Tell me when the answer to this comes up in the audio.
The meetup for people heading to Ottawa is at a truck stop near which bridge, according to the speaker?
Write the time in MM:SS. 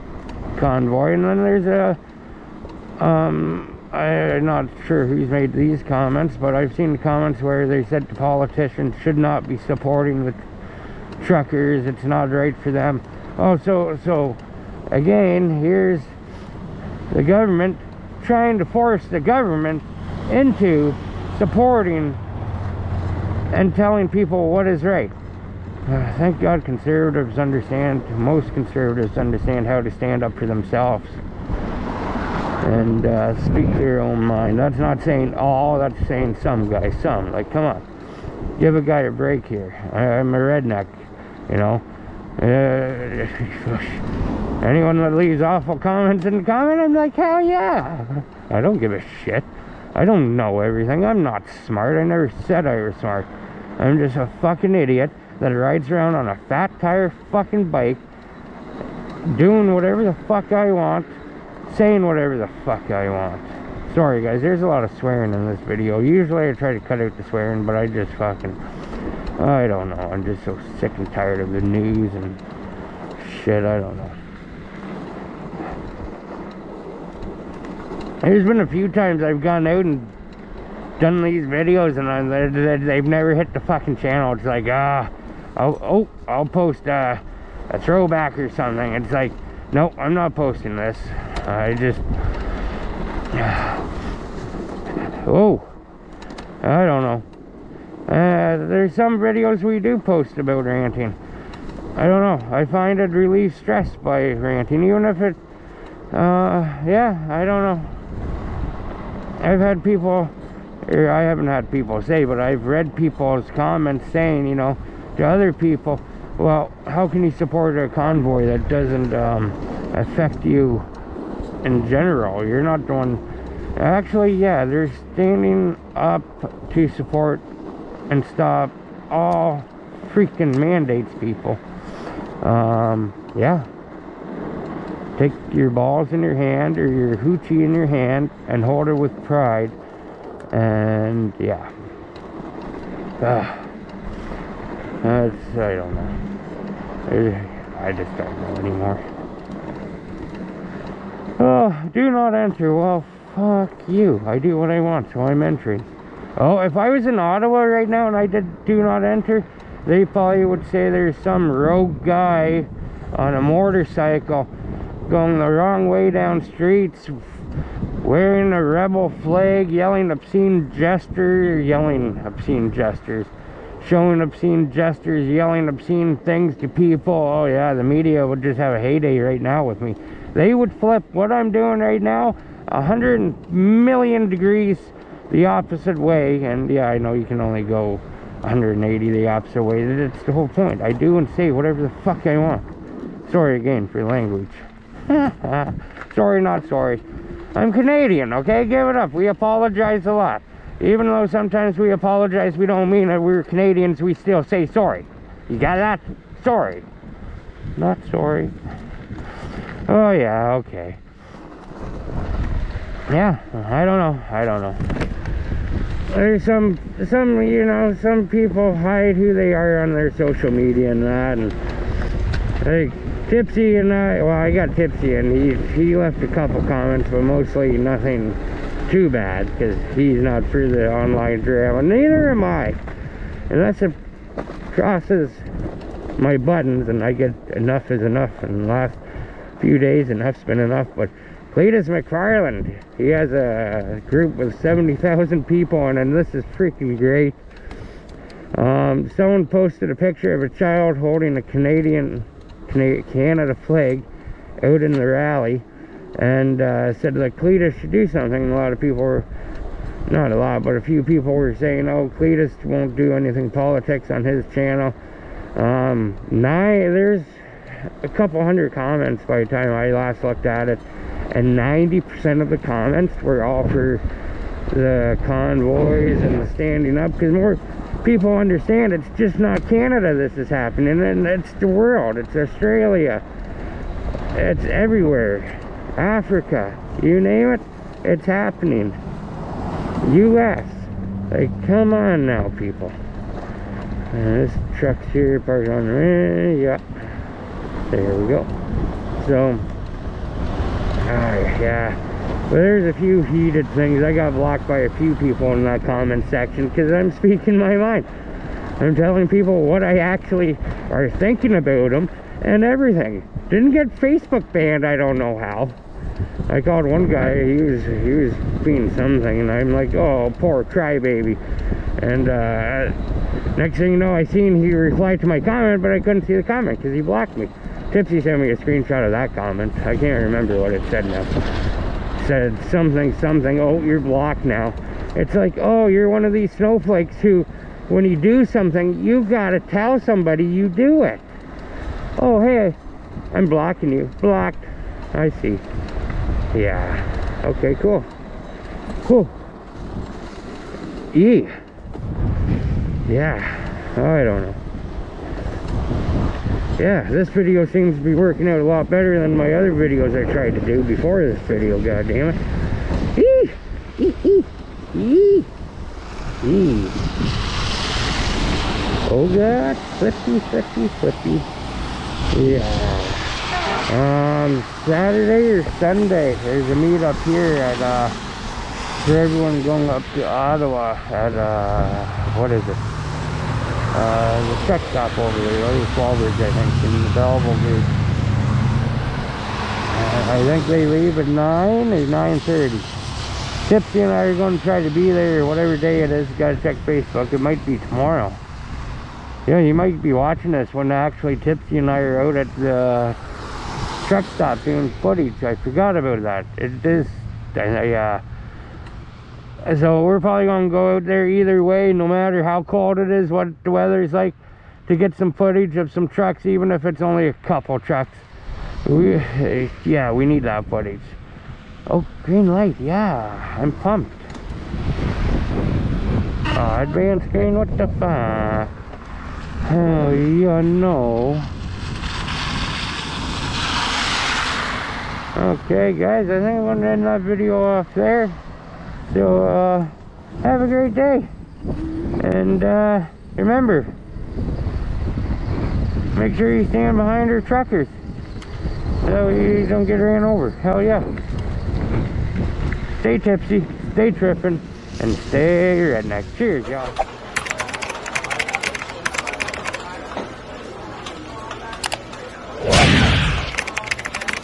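06:27.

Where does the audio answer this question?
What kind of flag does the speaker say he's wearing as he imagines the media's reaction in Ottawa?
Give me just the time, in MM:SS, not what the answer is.
02:48.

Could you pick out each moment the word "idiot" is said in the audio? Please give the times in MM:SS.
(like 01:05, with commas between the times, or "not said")
00:54.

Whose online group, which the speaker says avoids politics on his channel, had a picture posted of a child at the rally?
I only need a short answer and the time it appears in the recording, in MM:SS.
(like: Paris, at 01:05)
Cleetus McFarland, at 04:01.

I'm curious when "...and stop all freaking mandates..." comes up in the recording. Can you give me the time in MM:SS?
02:08.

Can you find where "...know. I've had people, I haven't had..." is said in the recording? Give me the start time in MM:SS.
01:47.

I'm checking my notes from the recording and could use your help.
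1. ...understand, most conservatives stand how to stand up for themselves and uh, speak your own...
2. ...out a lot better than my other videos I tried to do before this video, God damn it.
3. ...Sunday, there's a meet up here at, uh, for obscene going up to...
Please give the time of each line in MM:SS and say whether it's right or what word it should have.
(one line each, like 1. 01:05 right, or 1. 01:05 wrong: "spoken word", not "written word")
1. 00:27 wrong: "understand", not "stand"
2. 05:58 right
3. 06:15 wrong: "everyone", not "obscene".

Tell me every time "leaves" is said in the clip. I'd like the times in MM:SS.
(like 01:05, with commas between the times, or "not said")
00:45, 06:30.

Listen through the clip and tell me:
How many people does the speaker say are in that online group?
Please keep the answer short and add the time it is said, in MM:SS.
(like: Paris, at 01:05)
70,000, at 04:04.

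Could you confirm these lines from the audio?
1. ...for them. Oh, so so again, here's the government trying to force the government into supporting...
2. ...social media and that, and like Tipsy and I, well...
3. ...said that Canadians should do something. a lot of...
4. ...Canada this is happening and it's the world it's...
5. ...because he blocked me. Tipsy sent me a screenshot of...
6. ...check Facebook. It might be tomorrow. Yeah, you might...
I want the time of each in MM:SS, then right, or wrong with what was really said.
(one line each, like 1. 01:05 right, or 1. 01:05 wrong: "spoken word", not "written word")
1. 00:12 right
2. 03:40 right
3. 04:16 wrong: "Cleetus", not "Canadians"
4. 04:39 right
5. 05:26 right
6. 06:36 right.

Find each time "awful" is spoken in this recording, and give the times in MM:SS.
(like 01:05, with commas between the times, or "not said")
00:45.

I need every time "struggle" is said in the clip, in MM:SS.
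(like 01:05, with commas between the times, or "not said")
not said.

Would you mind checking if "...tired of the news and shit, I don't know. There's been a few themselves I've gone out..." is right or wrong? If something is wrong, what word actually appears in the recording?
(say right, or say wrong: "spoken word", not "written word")
wrong: "times", not "themselves".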